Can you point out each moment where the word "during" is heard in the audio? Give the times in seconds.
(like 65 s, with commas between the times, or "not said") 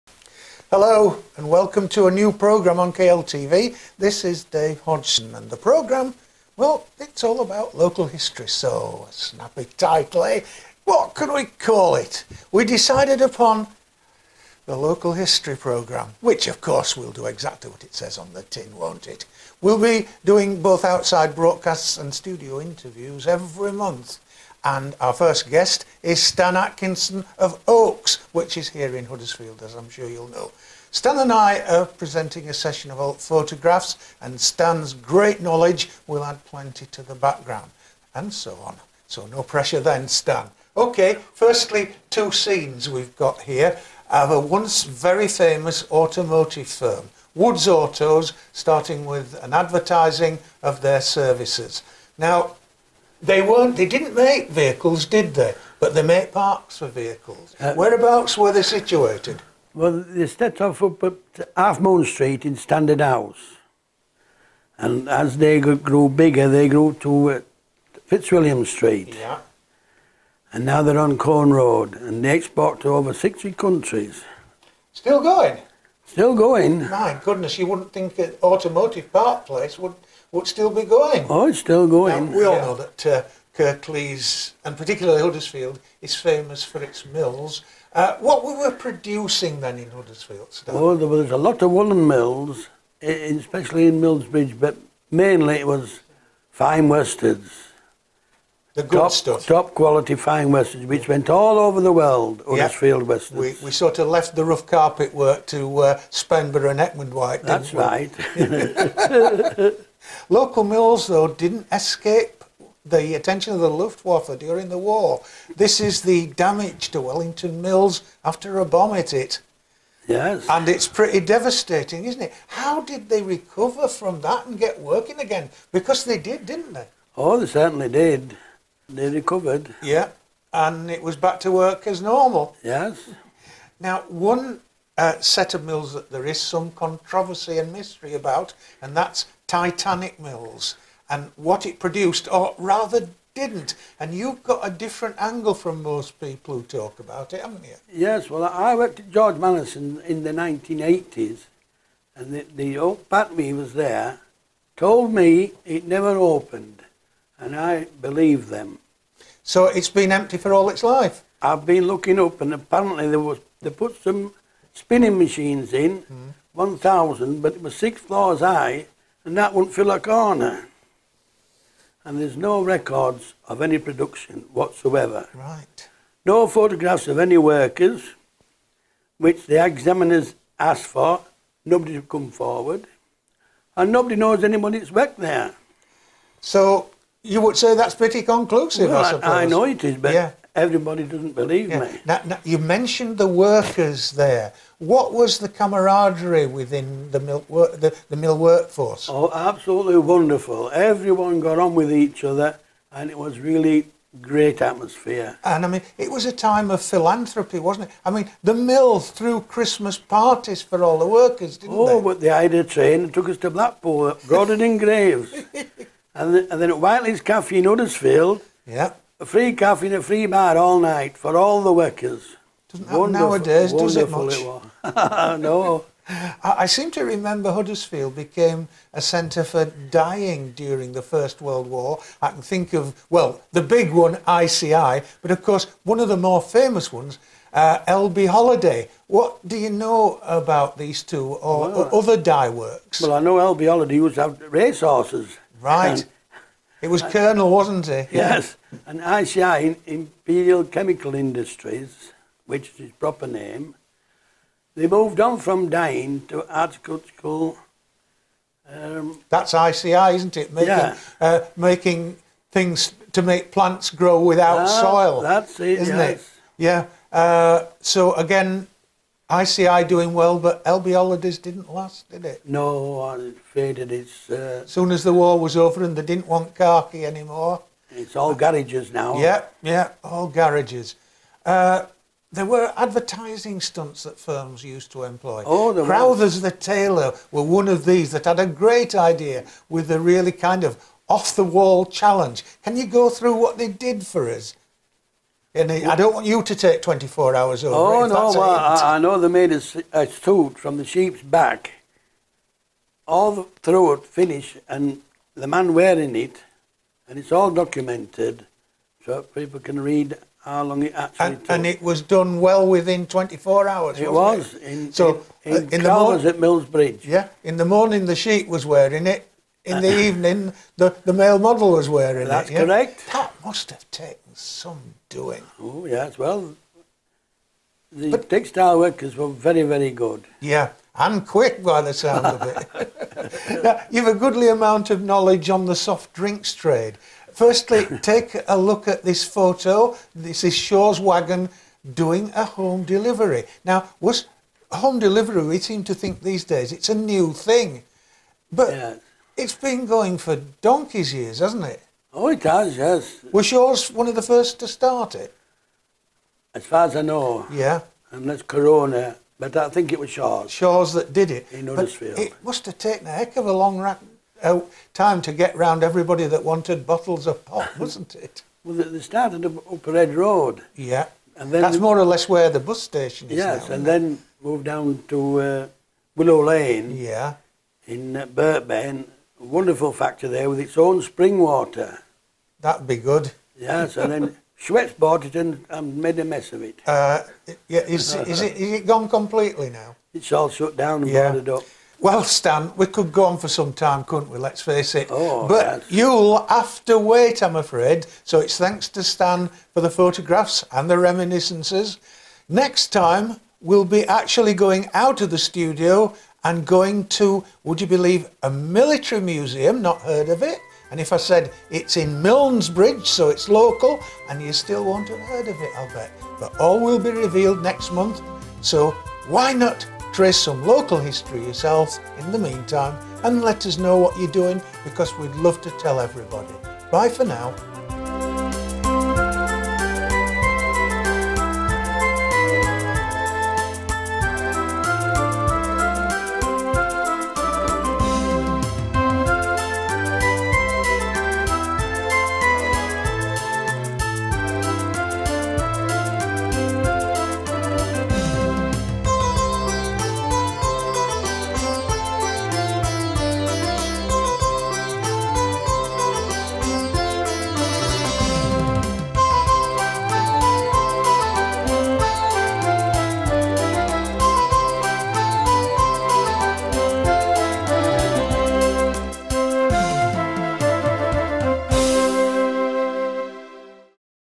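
114 s, 230 s.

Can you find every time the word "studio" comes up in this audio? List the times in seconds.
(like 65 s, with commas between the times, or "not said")
22 s, 405 s.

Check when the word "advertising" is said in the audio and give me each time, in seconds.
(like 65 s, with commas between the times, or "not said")
49 s, 282 s.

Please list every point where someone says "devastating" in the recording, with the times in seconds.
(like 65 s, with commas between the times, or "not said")
121 s.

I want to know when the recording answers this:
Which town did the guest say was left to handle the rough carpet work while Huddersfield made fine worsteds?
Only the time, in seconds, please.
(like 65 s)
105 s.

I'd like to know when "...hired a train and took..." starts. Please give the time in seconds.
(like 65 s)
212 s.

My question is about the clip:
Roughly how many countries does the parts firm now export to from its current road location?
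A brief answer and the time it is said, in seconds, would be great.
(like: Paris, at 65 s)
60, at 72 s.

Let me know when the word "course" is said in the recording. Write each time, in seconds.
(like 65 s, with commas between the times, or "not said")
16 s, 235 s.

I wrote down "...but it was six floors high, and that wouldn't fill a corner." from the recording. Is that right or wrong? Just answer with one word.
right.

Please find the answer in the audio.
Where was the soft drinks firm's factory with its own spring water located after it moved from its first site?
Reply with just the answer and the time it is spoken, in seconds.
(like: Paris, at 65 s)
Willow Lane, at 376 s.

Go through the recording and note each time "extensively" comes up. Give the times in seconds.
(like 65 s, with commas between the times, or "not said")
not said.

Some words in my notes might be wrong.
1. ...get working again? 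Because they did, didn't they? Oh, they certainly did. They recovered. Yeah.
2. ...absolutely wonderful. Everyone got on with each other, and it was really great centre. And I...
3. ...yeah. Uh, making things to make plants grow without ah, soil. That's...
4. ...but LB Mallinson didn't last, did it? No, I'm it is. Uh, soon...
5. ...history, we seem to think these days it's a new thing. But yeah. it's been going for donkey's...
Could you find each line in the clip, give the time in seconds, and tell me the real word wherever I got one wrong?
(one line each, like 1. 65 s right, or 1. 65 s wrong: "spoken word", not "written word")
1. 124 s right
2. 199 s wrong: "atmosphere", not "centre"
3. 260 s right
4. 270 s wrong: "Hollidays", not "Mallinson"
5. 344 s wrong: "delivery", not "history".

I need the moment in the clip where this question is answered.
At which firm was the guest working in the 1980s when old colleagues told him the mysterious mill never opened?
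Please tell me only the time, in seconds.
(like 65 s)
149 s.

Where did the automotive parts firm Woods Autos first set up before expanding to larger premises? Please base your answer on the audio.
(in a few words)
Half Moon Street.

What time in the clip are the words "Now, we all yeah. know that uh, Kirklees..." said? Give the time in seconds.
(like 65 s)
82 s.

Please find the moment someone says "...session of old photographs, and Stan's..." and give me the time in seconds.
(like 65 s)
32 s.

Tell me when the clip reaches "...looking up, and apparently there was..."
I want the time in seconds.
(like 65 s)
161 s.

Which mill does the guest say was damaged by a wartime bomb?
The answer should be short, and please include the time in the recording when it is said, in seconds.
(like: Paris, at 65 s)
Wellington Mills, at 117 s.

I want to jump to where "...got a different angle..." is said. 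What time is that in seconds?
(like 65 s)
144 s.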